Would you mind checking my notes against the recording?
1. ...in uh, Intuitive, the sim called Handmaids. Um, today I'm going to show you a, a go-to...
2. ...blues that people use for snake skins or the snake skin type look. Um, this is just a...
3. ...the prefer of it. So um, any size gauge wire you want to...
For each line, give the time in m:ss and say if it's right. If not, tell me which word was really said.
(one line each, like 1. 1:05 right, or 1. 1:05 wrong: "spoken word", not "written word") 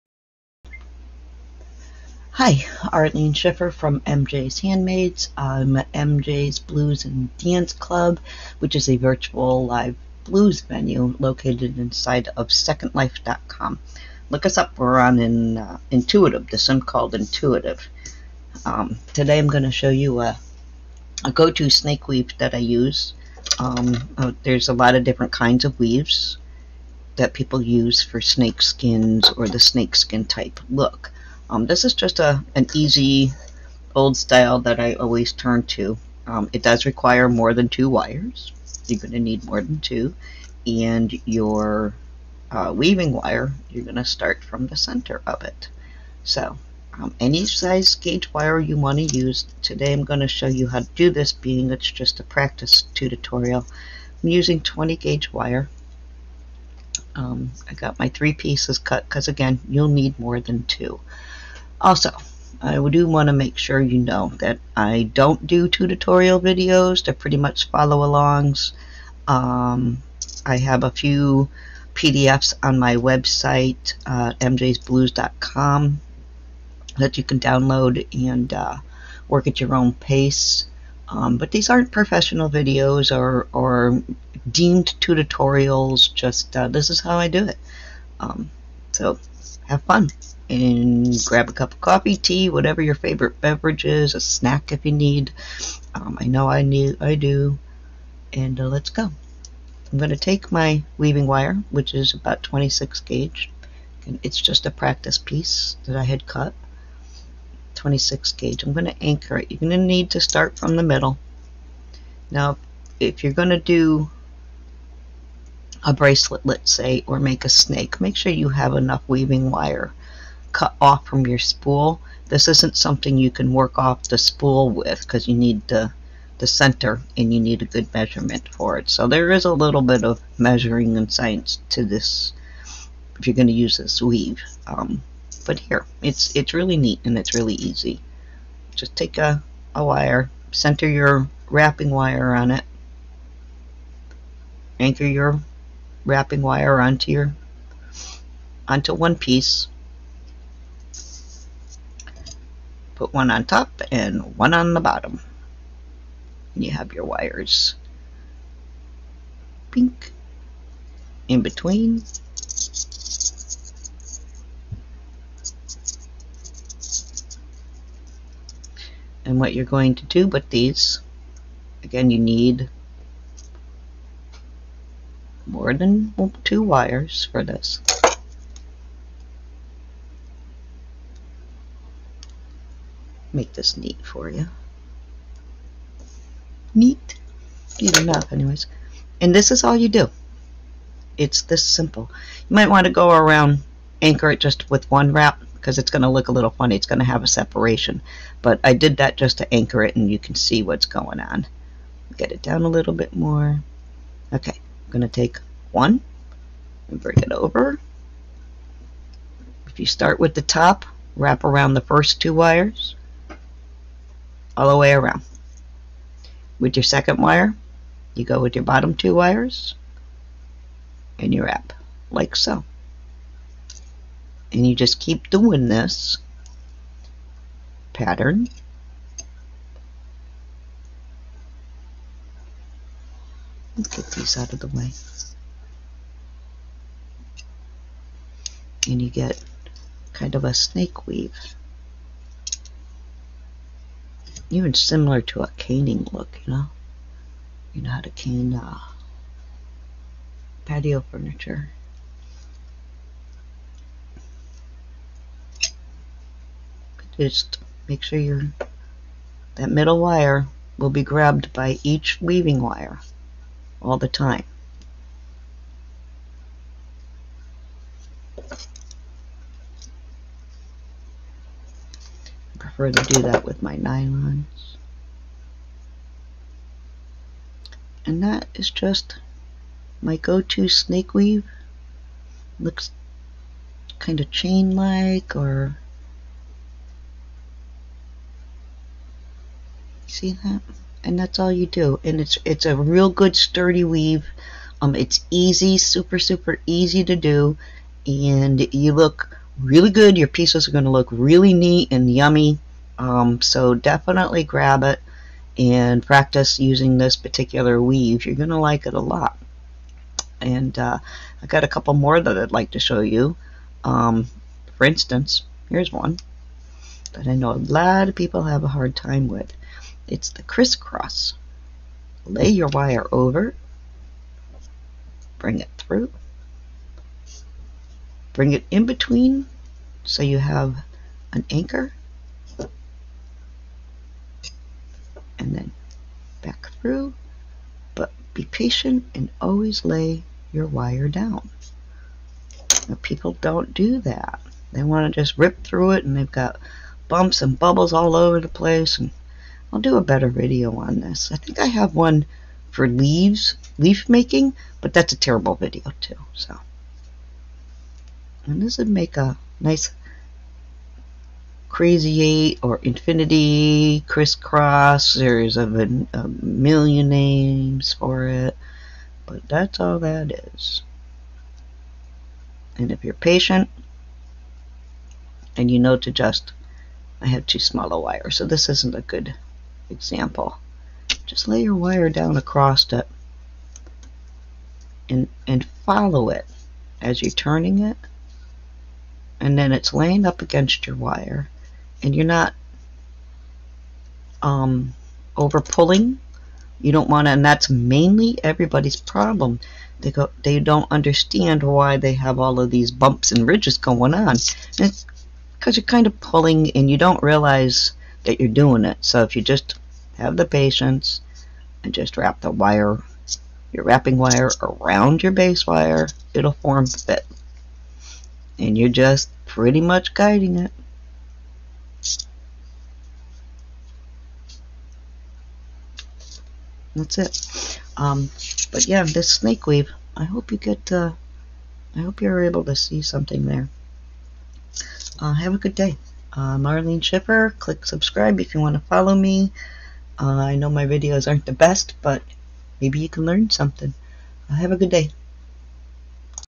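1. 0:15 wrong: "Intuitive", not "Handmaids"
2. 0:25 wrong: "weaves", not "blues"
3. 0:44 wrong: "center", not "prefer".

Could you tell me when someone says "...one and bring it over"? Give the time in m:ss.
3:25.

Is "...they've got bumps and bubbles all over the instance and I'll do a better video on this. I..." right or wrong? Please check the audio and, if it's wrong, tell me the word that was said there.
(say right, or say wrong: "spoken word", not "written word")
wrong: "place", not "instance".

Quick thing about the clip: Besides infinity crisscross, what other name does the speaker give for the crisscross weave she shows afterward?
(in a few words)
Crazy eight.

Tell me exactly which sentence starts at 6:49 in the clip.
So if you just have the patience and just wrap the wire, your wrapping wire around your base wire, it'll form fit.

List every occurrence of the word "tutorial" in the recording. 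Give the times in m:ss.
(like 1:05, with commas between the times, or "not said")
0:52, 1:05, 1:24.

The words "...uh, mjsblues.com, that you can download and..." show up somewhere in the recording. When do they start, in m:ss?
1:14.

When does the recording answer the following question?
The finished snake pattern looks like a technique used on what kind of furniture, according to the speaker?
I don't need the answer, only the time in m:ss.
4:10.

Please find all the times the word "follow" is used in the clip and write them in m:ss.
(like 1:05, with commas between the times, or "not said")
1:07, 6:25, 7:18.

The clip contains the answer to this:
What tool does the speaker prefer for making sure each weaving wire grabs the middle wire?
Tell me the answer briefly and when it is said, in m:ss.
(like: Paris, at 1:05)
Nylons, at 4:33.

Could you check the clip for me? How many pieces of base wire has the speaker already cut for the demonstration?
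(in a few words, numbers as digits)
3.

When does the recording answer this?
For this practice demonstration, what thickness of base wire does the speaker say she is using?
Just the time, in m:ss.
0:54.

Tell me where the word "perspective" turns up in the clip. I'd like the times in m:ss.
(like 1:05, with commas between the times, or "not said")
not said.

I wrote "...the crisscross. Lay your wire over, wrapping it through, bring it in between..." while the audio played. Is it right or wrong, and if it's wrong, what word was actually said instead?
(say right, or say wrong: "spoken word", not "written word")
wrong: "bring", not "wrapping".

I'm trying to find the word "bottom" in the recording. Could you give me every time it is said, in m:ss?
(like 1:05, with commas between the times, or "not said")
2:34, 3:38.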